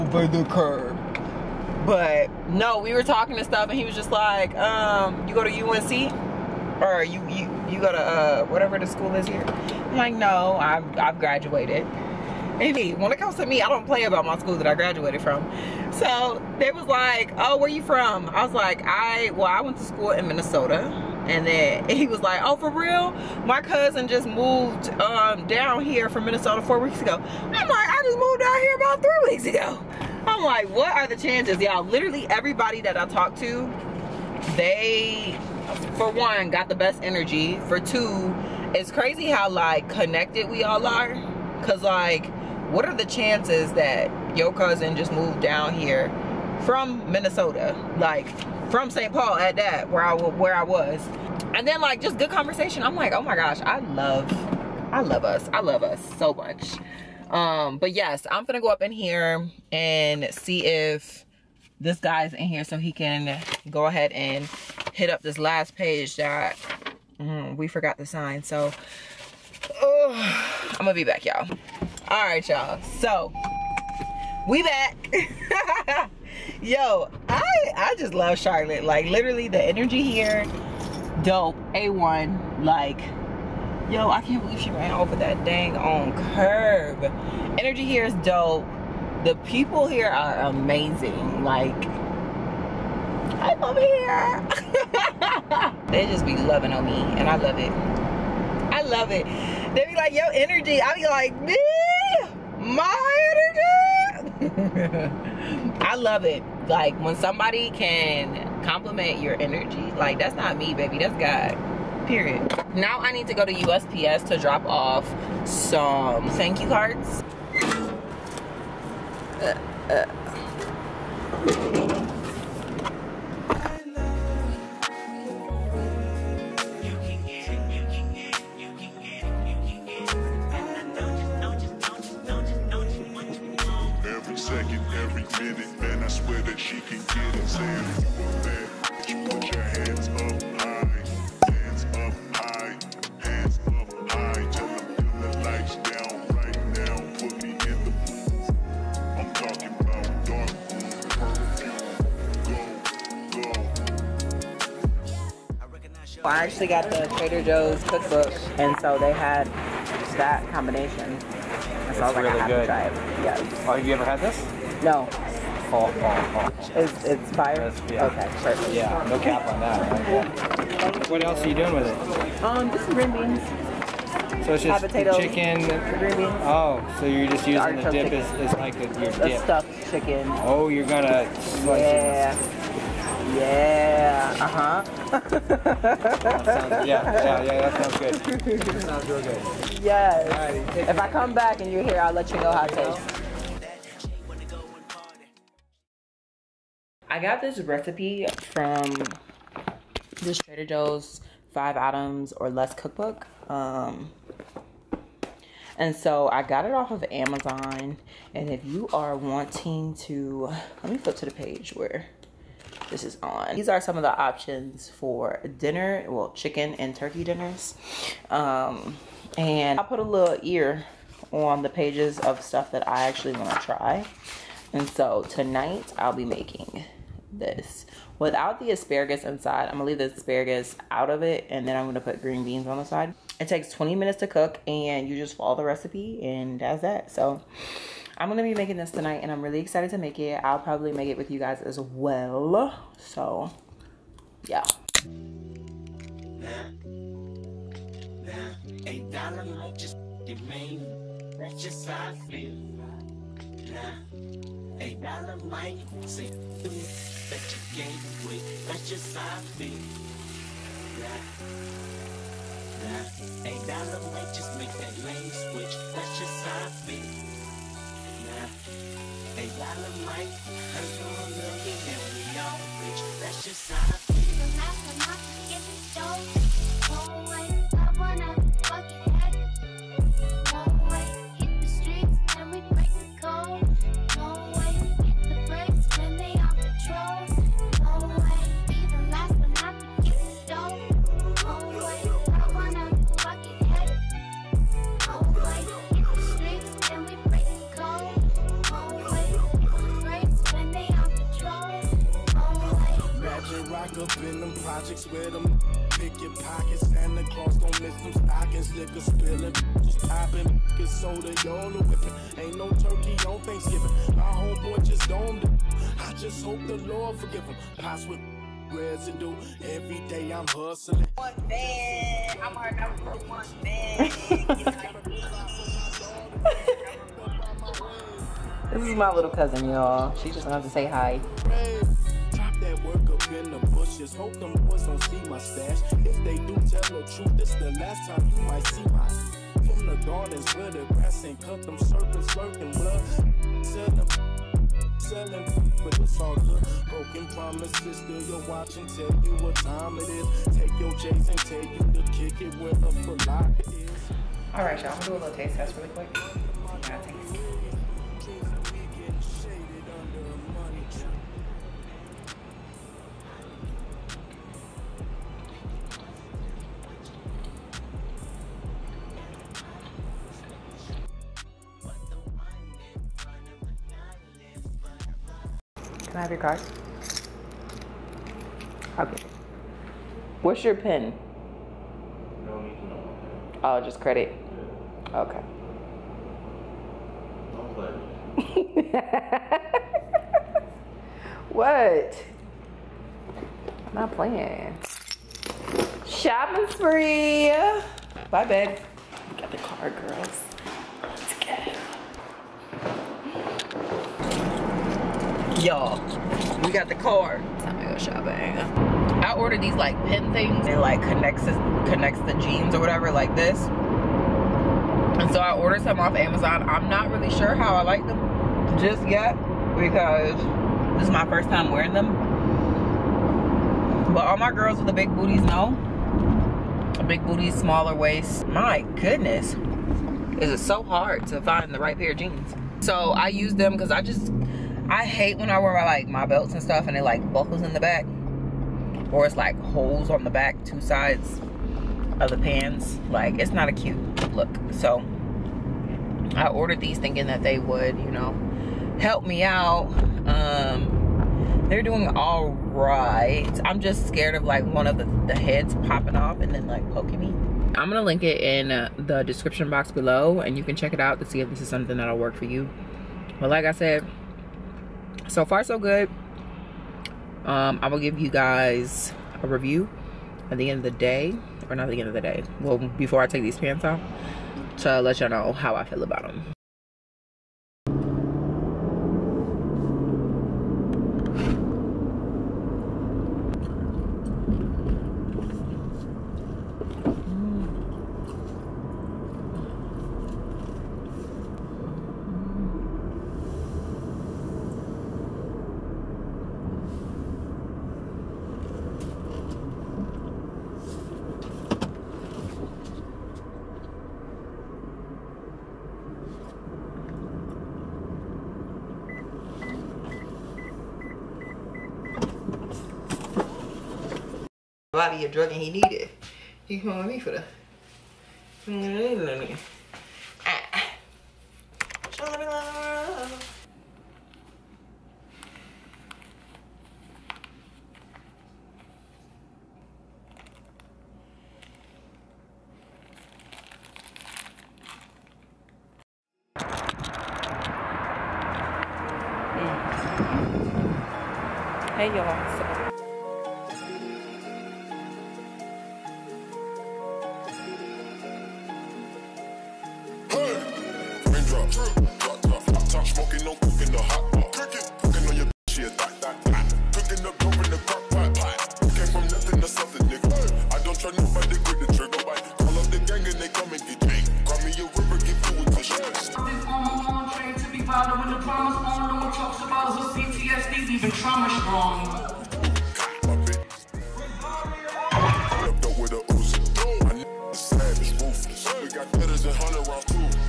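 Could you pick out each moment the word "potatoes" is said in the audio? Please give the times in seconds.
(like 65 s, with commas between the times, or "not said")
174 s.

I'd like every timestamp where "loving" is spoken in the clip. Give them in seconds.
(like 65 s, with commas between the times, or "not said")
96 s.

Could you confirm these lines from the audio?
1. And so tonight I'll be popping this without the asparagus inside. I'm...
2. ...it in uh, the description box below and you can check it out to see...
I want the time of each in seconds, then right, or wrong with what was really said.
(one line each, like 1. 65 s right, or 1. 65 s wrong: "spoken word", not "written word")
1. 224 s wrong: "making", not "popping"
2. 458 s right.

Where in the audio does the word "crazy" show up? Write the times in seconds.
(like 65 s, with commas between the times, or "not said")
38 s.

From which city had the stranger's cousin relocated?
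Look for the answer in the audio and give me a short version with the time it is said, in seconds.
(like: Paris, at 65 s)
St. Paul, at 48 s.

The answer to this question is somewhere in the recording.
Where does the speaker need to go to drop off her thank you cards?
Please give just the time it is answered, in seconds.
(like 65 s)
113 s.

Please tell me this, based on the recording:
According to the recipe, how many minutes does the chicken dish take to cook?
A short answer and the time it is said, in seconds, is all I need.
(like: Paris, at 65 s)
20, at 233 s.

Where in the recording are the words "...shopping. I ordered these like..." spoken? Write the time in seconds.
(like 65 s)
407 s.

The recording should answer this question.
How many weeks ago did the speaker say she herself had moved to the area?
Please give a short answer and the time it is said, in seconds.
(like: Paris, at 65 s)
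3, at 29 s.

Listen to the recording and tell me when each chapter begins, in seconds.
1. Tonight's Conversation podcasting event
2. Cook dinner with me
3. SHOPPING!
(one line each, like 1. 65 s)
1. 534 s
2. 223 s
3. 374 s.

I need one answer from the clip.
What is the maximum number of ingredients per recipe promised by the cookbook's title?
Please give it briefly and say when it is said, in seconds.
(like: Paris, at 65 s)
5, at 201 s.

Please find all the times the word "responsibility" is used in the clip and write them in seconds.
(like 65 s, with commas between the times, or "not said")
not said.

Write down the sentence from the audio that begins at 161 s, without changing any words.
That so it's I was like, really I have good.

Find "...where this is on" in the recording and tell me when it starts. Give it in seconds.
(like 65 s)
211 s.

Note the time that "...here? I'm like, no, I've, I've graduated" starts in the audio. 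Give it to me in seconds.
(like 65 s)
9 s.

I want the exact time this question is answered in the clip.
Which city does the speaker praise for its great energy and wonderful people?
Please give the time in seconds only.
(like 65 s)
78 s.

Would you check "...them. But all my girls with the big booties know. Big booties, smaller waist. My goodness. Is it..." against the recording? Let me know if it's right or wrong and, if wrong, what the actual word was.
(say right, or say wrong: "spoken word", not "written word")
right.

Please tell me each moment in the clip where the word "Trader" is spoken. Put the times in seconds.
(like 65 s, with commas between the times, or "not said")
157 s, 200 s.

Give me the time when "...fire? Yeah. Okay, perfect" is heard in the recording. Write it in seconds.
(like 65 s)
167 s.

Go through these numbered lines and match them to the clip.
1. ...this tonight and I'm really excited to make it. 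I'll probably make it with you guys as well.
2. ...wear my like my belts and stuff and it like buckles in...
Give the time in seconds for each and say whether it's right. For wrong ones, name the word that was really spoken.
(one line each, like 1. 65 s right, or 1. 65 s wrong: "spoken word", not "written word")
1. 238 s right
2. 435 s right.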